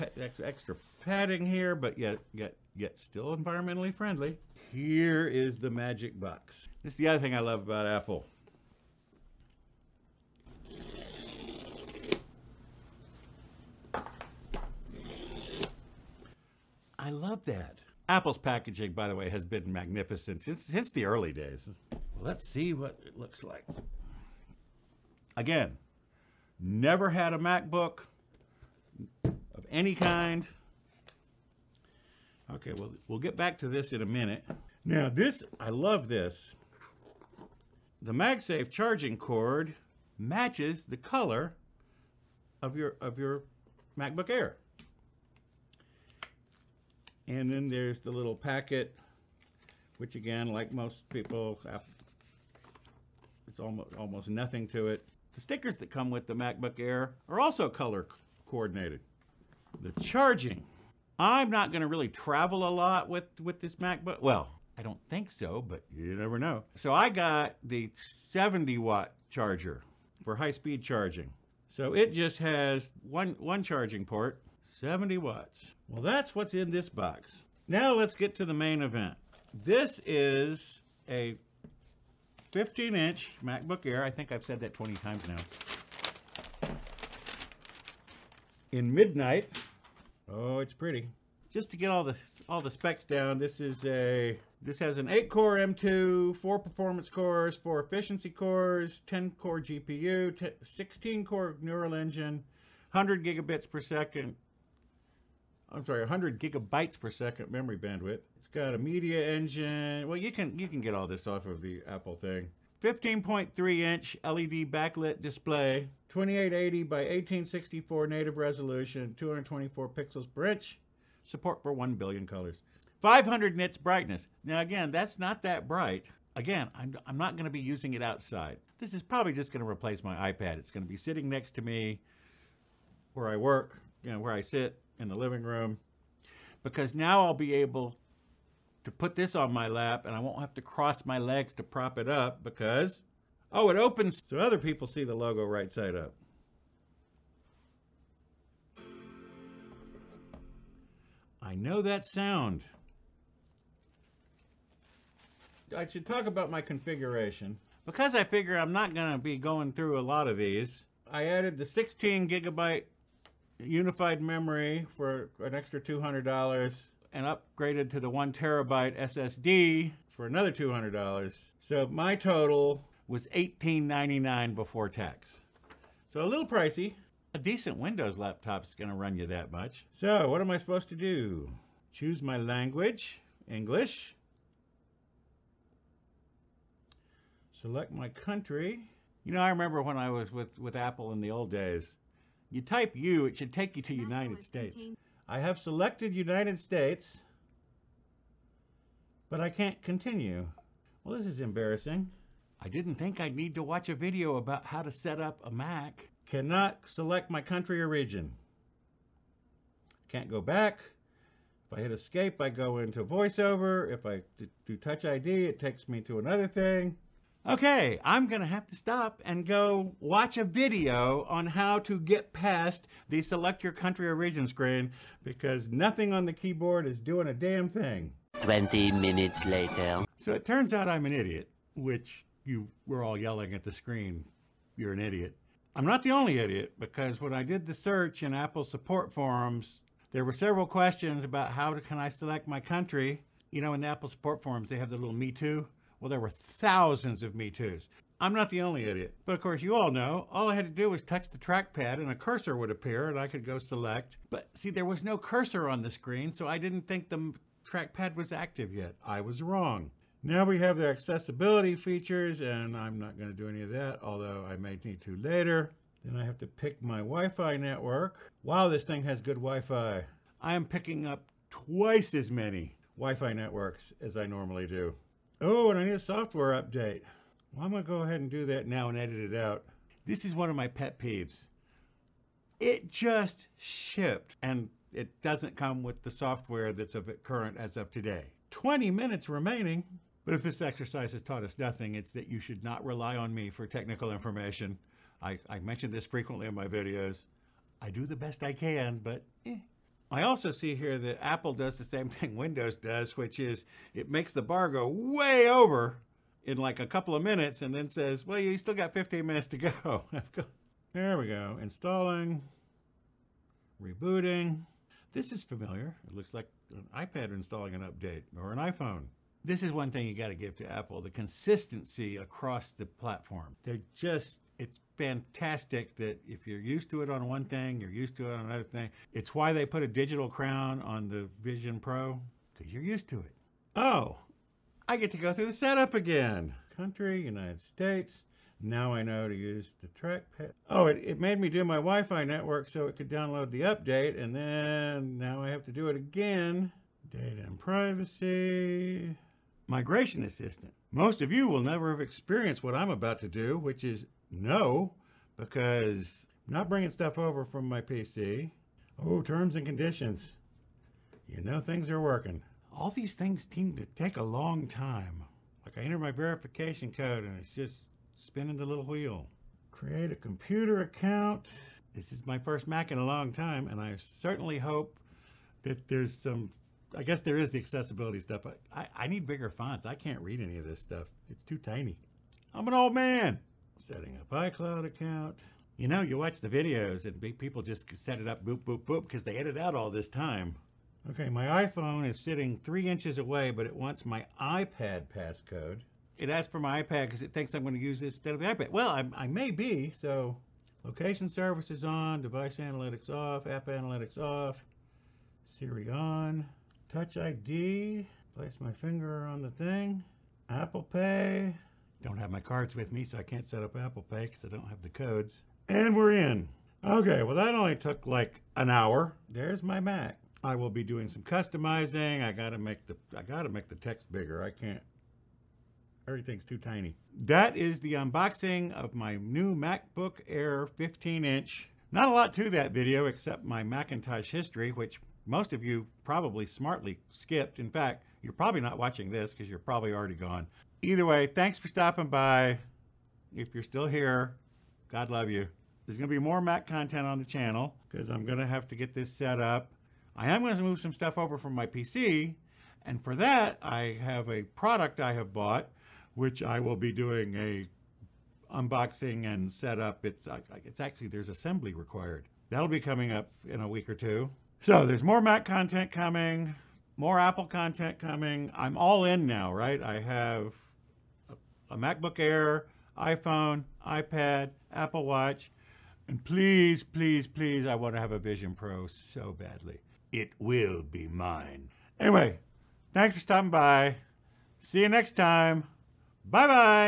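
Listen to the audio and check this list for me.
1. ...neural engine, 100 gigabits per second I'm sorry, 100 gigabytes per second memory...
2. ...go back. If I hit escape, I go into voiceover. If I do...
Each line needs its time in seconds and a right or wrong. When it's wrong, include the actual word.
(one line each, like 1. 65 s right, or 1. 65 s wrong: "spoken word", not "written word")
1. 101 s right
2. 210 s right.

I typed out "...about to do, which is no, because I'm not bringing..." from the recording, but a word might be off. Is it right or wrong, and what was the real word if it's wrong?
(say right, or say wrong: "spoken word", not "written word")
right.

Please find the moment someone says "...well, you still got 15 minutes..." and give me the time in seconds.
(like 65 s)
308 s.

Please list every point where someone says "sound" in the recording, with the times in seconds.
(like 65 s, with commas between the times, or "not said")
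152 s.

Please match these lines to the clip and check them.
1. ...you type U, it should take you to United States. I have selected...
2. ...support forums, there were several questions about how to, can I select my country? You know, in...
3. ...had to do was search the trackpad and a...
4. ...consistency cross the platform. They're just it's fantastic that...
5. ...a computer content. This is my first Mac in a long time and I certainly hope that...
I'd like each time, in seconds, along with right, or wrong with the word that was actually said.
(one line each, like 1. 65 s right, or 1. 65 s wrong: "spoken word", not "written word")
1. 192 s right
2. 238 s right
3. 250 s wrong: "touch", not "search"
4. 321 s wrong: "across", not "cross"
5. 370 s wrong: "account", not "content".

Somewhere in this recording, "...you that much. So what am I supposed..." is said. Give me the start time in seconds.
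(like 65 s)
179 s.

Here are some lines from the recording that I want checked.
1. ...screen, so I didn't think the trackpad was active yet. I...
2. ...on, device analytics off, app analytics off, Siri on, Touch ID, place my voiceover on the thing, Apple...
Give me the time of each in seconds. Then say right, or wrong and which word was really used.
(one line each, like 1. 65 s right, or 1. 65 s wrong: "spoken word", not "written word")
1. 255 s right
2. 401 s wrong: "finger", not "voiceover".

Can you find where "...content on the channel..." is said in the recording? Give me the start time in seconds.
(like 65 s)
446 s.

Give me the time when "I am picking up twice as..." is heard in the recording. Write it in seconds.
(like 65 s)
270 s.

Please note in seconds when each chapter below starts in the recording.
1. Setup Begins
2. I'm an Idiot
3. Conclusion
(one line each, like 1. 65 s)
1. 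178 s
2. 228 s
3. 414 s.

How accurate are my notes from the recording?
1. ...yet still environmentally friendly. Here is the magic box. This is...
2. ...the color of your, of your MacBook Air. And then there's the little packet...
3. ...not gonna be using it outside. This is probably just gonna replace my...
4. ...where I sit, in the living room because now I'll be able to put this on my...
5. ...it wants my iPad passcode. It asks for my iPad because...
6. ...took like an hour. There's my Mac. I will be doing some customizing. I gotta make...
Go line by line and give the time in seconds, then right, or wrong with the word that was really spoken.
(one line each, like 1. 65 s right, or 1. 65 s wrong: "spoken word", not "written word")
1. 2 s right
2. 40 s right
3. 127 s right
4. 134 s right
5. 393 s right
6. 417 s right.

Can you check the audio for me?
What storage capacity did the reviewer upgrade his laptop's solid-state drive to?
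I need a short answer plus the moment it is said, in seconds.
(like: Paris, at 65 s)
1 terabyte, at 168 s.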